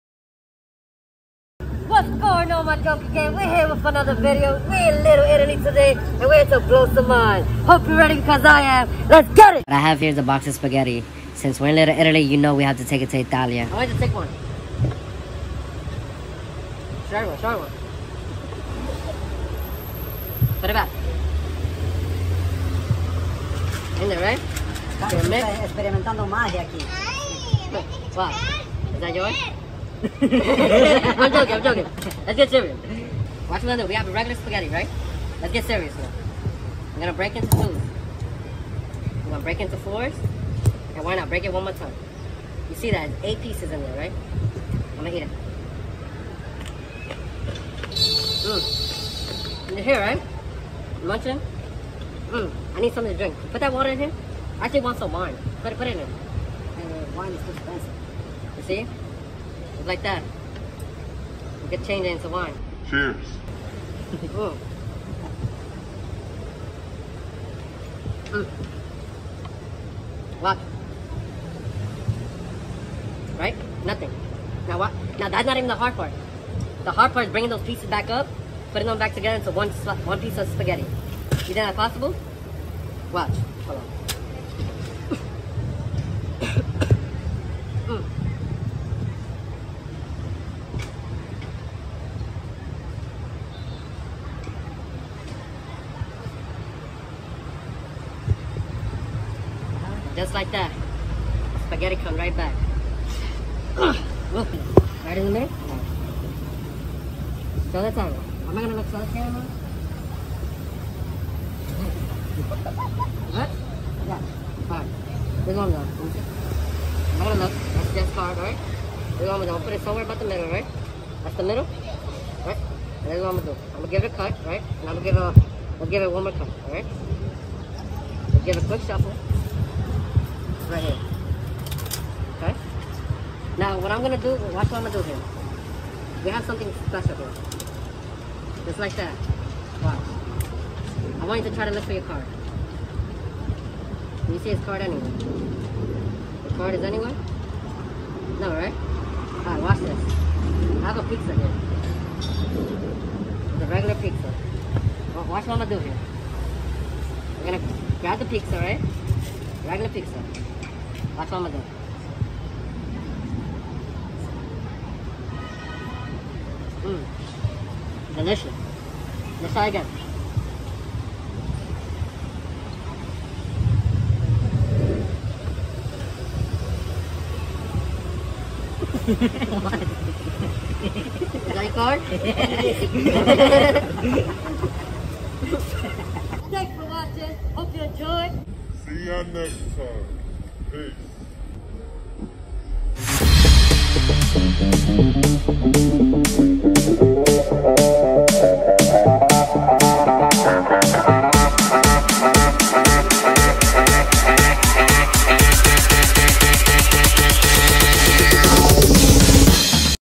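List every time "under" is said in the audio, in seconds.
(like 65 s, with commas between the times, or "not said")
33 s.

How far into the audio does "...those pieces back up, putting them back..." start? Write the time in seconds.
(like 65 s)
77 s.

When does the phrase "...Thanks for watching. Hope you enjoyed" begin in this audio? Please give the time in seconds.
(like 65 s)
186 s.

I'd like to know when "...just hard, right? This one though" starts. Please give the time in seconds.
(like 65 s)
117 s.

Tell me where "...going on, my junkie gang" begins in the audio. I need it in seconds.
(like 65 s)
2 s.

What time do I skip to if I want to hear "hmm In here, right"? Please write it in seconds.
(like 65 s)
48 s.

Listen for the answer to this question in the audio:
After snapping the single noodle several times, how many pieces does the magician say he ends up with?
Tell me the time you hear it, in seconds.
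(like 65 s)
43 s.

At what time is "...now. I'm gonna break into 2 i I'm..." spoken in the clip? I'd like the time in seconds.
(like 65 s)
35 s.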